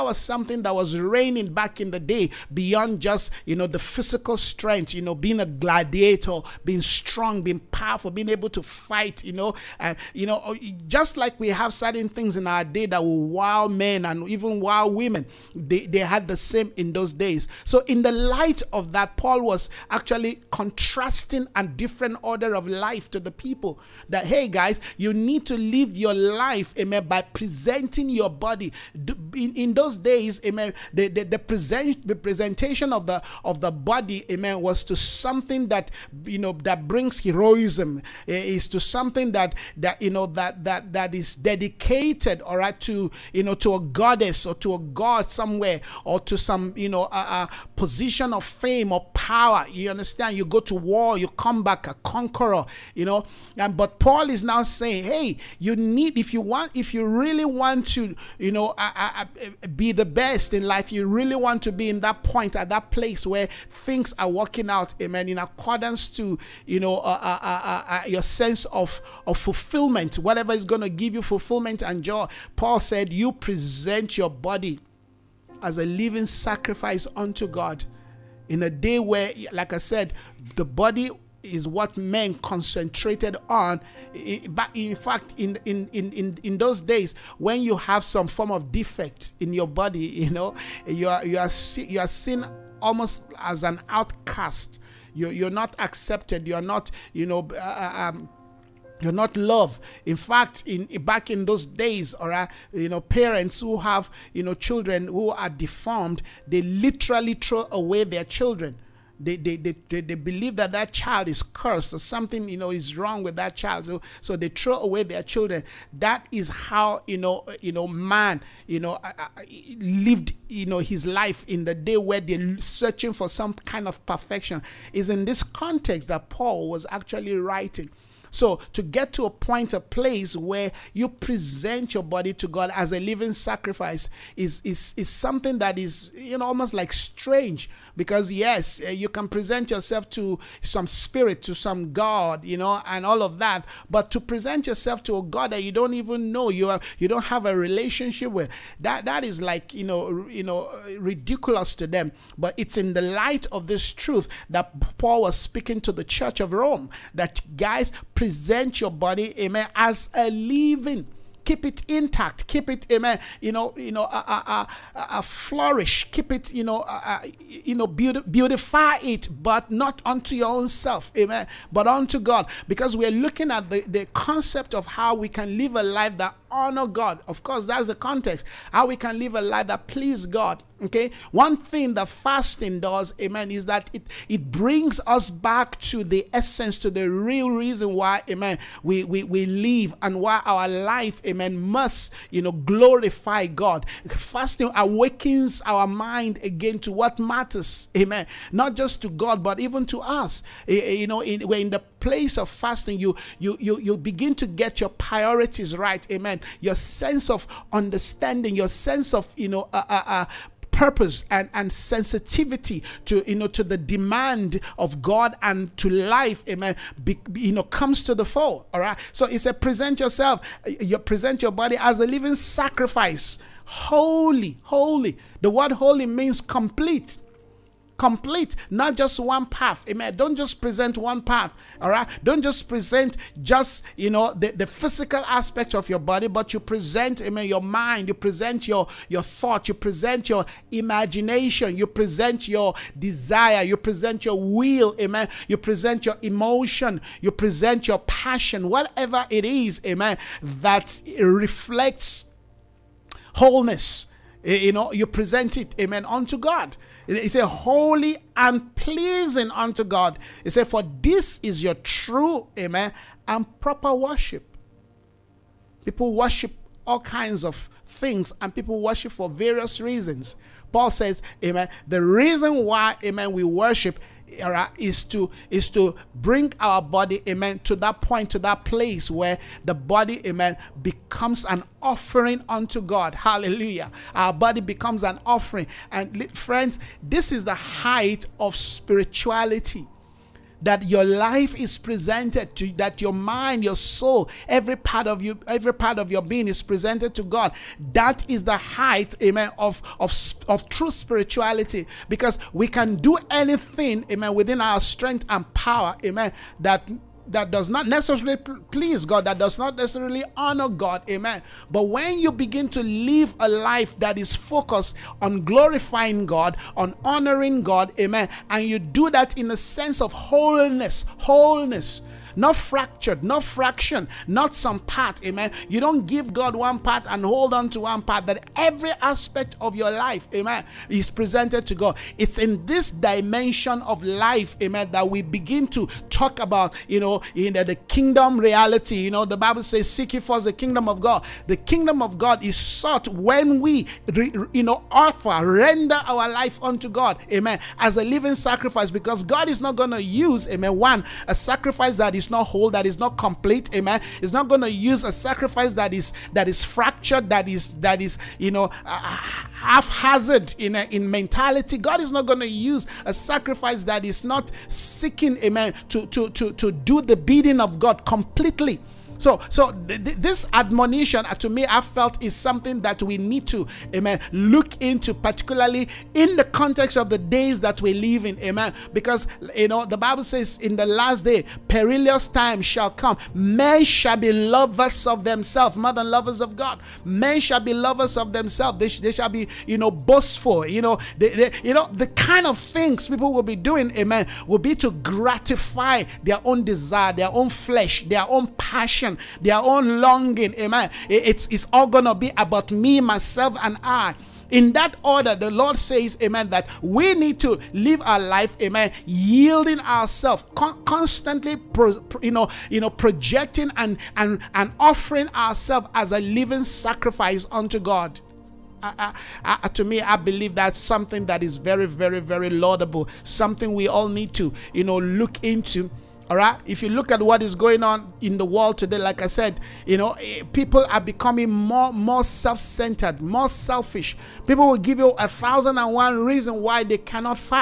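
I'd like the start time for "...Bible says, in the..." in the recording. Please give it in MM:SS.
06:19.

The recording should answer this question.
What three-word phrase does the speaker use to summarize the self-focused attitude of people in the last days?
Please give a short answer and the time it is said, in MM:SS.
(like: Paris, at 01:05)
Me, myself, and I, at 06:42.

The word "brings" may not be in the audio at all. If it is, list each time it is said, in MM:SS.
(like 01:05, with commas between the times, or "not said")
00:36, 03:04, 04:36.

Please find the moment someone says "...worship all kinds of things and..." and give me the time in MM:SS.
04:26.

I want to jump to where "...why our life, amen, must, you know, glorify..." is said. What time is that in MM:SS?
03:10.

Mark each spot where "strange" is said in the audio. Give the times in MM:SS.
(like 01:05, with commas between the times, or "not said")
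02:16.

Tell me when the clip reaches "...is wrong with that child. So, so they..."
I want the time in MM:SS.
01:52.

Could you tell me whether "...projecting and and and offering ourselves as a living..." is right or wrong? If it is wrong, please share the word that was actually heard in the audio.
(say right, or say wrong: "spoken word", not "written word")
right.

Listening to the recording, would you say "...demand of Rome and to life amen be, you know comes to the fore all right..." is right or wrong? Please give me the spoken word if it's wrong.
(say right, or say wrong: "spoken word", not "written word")
wrong: "God", not "Rome".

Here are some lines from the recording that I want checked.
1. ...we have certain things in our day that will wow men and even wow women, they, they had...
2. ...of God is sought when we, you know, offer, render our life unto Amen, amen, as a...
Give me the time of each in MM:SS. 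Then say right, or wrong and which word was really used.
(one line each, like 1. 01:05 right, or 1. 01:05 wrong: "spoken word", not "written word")
1. 00:11 right
2. 05:42 wrong: "God", not "Amen".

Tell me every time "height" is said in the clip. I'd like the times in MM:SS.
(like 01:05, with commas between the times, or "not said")
04:47, 04:58.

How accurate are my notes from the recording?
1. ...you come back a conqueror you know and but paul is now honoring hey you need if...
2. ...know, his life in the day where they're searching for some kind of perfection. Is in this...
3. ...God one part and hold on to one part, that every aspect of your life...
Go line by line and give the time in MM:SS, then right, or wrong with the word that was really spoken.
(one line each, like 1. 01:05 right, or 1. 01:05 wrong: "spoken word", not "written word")
1. 00:51 wrong: "saying", not "honoring"
2. 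02:00 right
3. 05:26 right.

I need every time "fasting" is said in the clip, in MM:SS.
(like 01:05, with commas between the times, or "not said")
03:02, 03:14, 03:22.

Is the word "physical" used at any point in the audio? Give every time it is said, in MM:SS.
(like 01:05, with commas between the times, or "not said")
00:03, 03:54.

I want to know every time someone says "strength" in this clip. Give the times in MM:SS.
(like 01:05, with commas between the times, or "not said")
00:04, 05:04.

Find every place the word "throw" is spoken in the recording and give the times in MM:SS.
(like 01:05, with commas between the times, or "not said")
01:47, 01:54.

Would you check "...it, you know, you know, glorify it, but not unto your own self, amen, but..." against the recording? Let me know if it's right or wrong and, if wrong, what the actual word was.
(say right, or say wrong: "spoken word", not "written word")
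wrong: "beautify", not "glorify".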